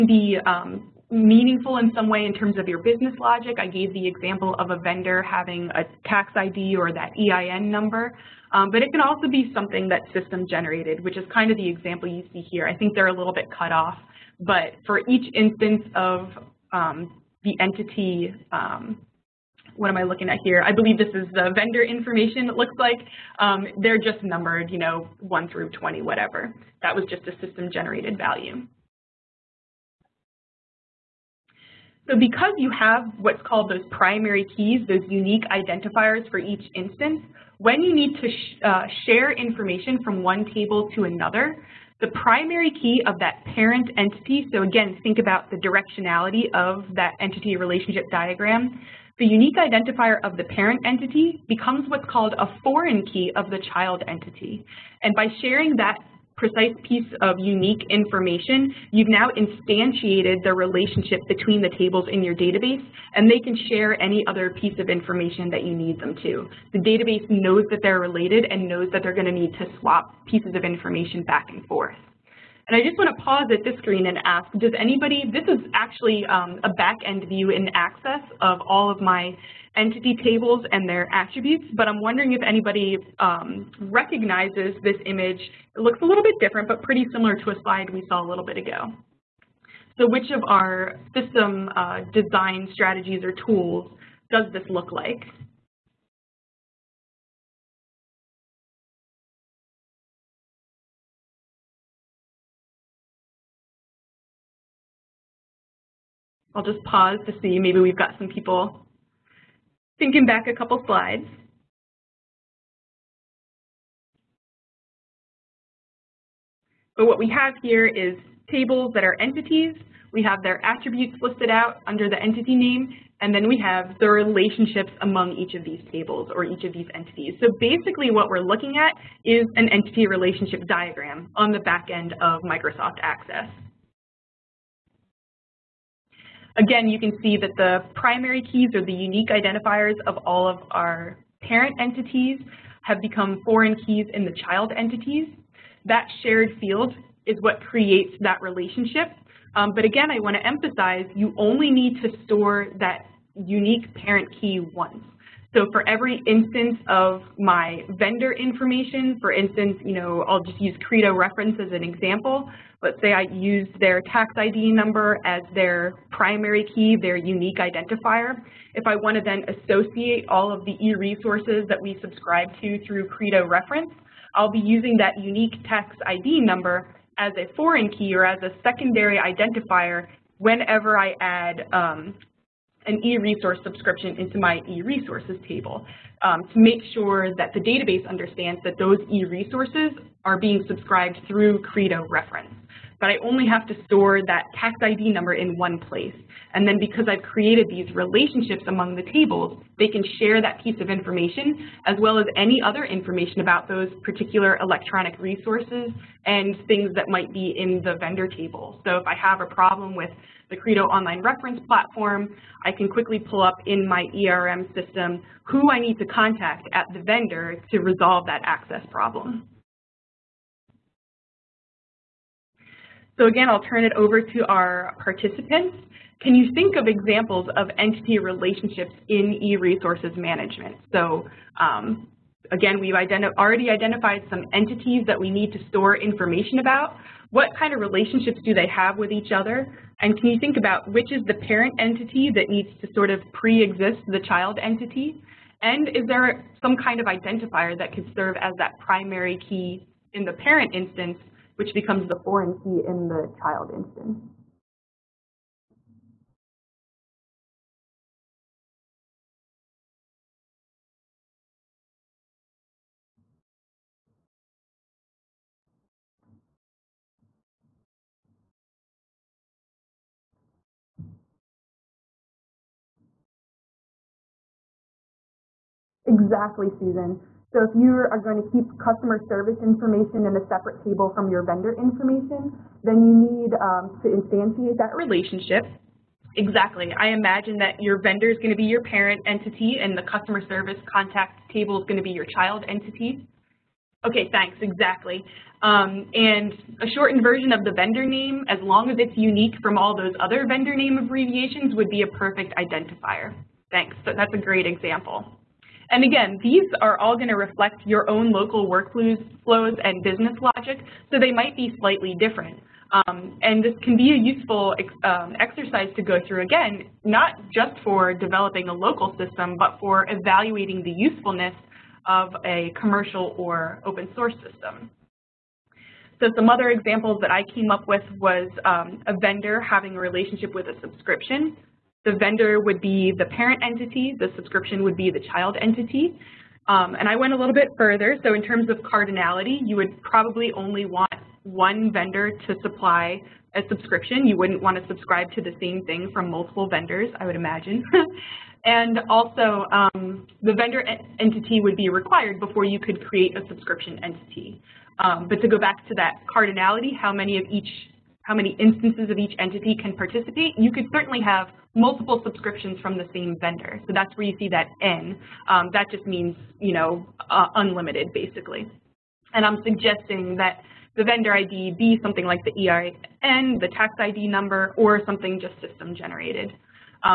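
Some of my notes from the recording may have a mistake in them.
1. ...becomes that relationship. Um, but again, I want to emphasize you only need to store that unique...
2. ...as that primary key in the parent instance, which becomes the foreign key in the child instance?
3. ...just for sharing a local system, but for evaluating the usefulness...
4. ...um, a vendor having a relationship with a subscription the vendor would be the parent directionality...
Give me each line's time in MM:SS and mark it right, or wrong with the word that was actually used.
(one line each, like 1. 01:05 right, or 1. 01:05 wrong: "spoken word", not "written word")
1. 02:27 wrong: "creates", not "becomes"
2. 04:08 right
3. 05:17 wrong: "developing", not "sharing"
4. 05:28 wrong: "entity", not "directionality".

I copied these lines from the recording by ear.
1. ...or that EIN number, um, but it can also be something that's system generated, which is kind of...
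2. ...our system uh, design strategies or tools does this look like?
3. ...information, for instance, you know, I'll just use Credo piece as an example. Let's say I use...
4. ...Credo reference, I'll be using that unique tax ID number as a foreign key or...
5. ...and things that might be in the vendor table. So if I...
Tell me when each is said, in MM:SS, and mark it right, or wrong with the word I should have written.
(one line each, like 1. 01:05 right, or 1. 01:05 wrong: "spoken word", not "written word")
1. 00:06 right
2. 01:30 right
3. 02:38 wrong: "reference", not "piece"
4. 02:53 right
5. 03:26 right.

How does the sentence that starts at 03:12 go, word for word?
But I only have to store that tax ID number in one place.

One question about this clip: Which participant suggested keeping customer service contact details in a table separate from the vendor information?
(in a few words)
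Susan.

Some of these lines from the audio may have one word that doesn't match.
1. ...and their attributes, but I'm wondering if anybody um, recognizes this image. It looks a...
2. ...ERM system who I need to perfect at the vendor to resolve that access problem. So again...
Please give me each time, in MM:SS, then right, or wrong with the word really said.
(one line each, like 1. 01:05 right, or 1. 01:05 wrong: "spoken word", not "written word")
1. 01:20 right
2. 03:34 wrong: "contact", not "perfect".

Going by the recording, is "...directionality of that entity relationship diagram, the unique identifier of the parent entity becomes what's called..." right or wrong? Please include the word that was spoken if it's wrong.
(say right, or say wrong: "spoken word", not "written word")
right.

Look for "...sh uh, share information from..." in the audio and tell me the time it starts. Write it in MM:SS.
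00:38.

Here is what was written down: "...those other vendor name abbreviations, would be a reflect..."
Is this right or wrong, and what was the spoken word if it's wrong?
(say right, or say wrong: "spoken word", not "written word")
wrong: "perfect", not "reflect".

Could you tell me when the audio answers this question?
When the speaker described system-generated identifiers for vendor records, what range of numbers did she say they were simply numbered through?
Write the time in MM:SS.
00:25.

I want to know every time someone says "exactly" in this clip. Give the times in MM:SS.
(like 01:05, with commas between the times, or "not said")
04:36, 04:46, 04:54.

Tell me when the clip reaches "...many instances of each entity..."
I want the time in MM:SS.
05:58.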